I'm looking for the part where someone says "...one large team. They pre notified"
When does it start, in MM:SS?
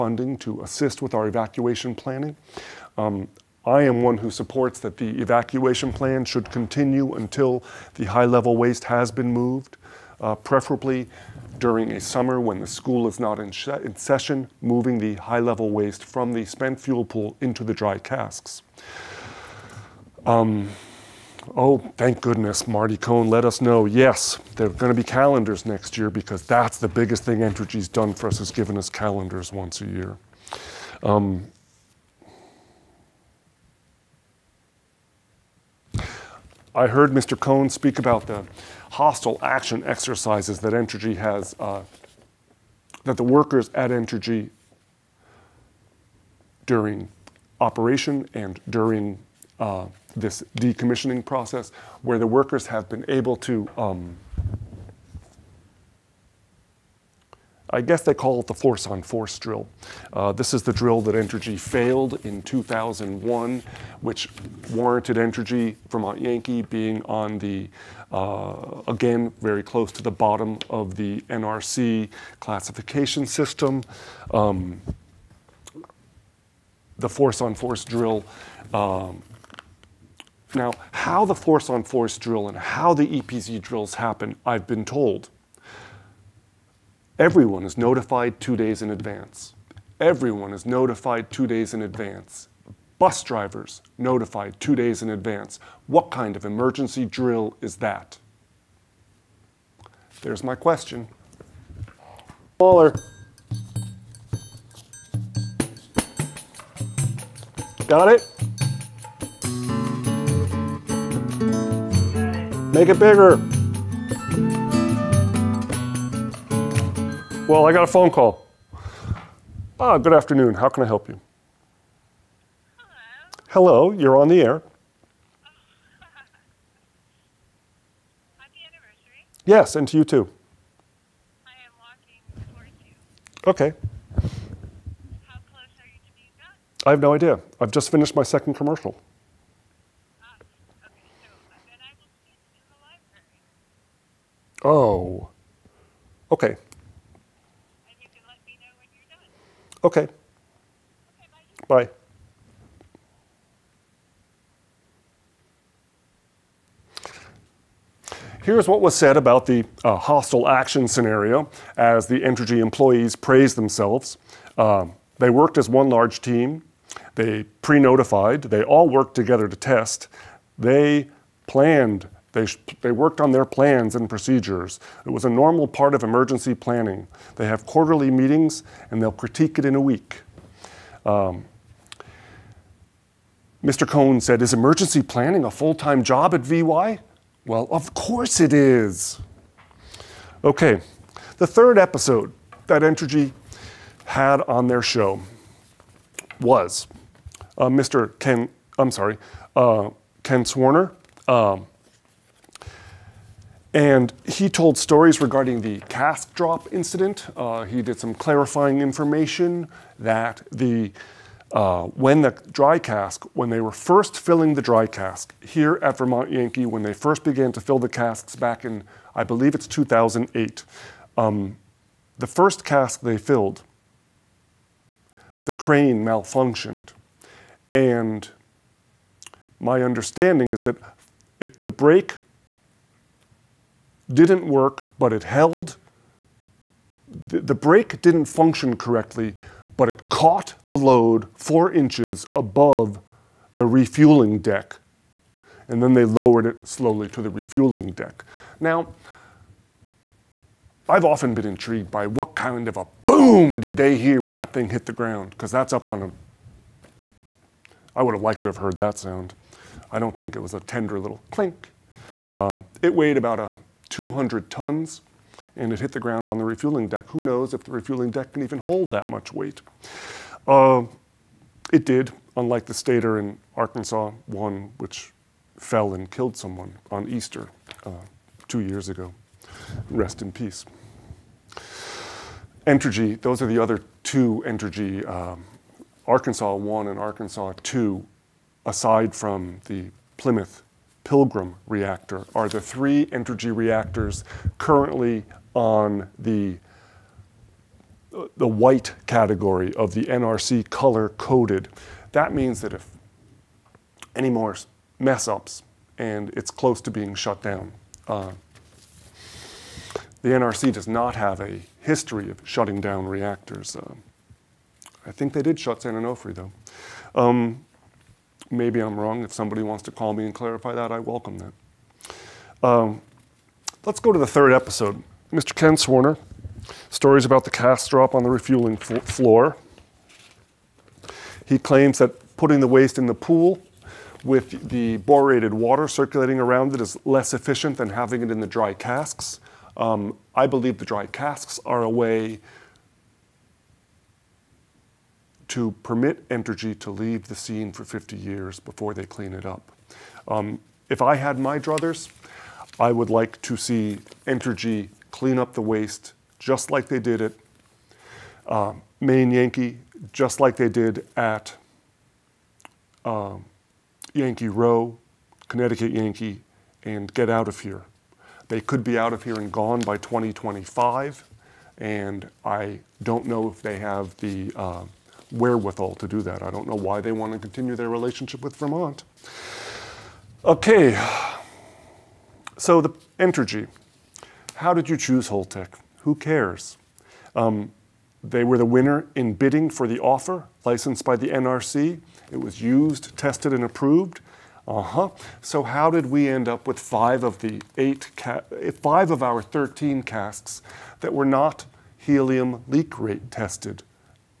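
02:45.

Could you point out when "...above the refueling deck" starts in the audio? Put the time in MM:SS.
04:02.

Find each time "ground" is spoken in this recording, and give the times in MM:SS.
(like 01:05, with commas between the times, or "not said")
04:14, 04:26.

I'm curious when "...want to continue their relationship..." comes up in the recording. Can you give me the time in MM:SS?
06:17.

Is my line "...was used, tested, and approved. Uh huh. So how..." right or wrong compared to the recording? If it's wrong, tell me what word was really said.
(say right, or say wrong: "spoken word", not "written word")
right.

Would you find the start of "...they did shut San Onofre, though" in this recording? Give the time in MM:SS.
05:15.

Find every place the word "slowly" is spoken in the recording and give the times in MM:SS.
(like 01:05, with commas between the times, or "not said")
04:06.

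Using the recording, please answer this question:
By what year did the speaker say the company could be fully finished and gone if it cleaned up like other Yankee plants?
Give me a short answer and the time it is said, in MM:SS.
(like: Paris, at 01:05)
2025, at 06:09.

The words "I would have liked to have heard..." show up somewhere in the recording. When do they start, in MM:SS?
04:17.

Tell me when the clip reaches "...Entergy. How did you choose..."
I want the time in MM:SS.
06:23.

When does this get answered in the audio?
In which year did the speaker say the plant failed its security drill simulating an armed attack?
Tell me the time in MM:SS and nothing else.
01:02.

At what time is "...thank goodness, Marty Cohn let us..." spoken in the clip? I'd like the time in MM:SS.
00:21.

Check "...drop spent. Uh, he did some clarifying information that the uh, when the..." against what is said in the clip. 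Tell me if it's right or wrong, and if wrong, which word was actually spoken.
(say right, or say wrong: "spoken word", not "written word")
wrong: "incident", not "spent".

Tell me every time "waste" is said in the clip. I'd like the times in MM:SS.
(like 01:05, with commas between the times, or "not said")
00:08, 00:15, 05:32, 05:55.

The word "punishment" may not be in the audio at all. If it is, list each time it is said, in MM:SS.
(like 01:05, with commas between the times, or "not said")
not said.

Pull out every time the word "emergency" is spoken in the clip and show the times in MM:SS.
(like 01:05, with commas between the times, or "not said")
01:36, 02:56, 03:04.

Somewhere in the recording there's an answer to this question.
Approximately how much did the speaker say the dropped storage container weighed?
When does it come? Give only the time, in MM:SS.
04:23.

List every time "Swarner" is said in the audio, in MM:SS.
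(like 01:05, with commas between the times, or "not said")
03:20, 05:25.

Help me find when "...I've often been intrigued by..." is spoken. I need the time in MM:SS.
04:10.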